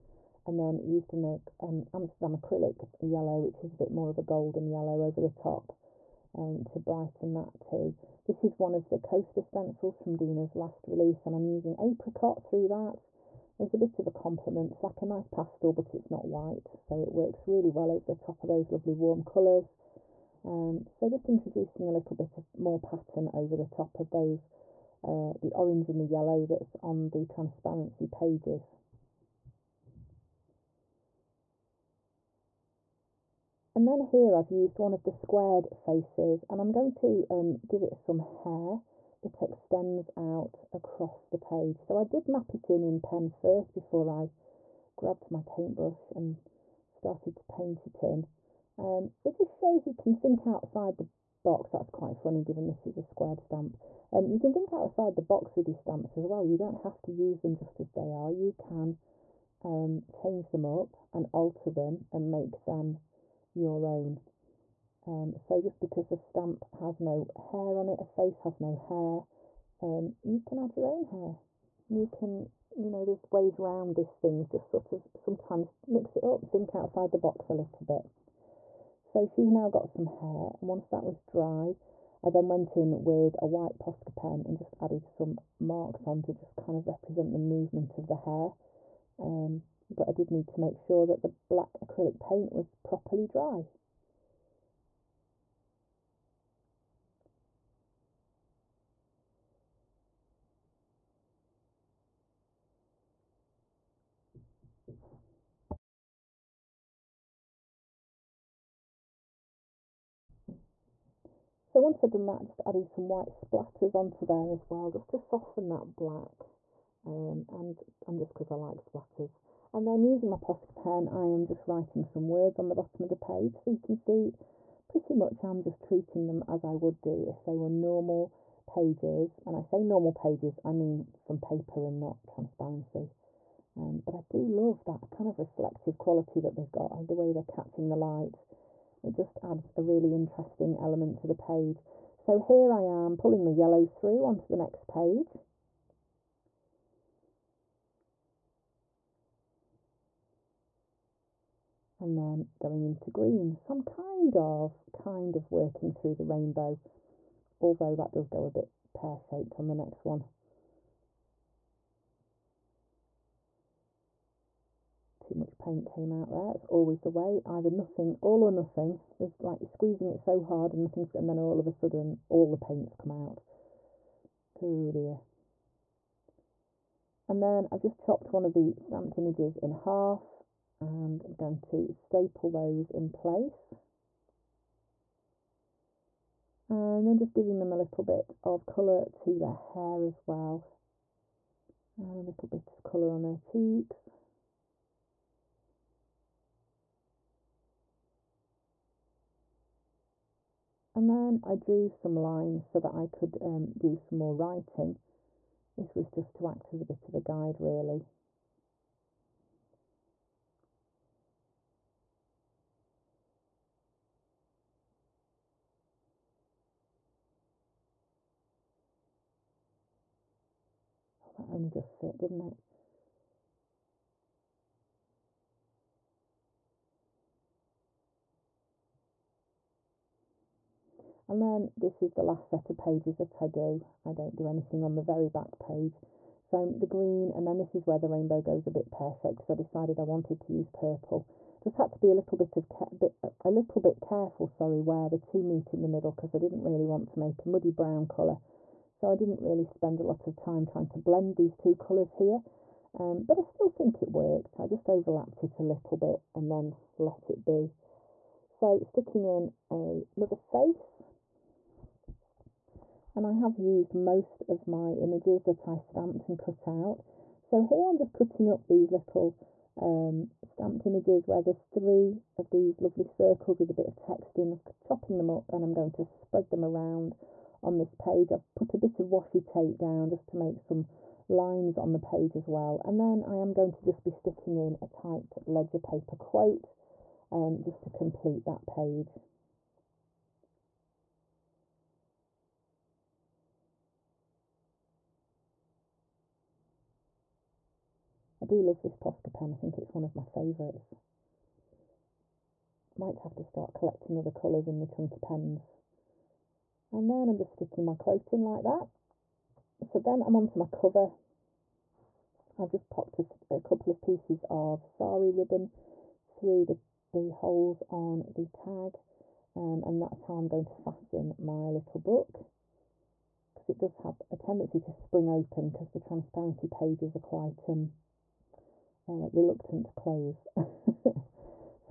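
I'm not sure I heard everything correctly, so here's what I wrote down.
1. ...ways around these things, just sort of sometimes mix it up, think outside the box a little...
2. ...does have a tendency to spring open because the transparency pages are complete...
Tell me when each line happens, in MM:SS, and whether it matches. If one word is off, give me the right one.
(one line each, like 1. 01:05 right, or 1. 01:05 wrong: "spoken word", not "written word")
1. 01:13 right
2. 05:23 wrong: "quite", not "complete".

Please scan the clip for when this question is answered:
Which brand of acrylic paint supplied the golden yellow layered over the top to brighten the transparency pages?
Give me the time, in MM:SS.
00:01.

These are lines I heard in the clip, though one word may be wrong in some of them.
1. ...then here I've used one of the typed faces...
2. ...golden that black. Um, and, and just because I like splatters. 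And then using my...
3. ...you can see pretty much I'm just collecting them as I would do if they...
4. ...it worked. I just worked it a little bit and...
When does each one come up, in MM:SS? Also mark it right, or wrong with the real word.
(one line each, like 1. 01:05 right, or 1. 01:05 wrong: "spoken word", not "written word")
1. 00:33 wrong: "squared", not "typed"
2. 01:55 wrong: "soften", not "golden"
3. 02:03 wrong: "treating", not "collecting"
4. 04:14 wrong: "overlapped", not "worked".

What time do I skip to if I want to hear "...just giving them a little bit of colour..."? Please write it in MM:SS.
03:07.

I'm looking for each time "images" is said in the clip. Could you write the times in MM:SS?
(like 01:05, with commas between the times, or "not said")
02:59, 04:24, 04:30.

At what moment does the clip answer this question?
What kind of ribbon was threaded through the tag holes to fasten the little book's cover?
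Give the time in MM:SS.
05:14.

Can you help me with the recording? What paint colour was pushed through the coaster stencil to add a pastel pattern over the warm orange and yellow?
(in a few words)
apricot.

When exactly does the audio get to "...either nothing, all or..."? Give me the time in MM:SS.
02:47.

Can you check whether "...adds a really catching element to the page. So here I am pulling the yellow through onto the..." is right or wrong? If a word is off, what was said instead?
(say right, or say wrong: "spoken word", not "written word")
wrong: "interesting", not "catching".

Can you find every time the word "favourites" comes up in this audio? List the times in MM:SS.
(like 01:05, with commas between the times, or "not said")
05:00.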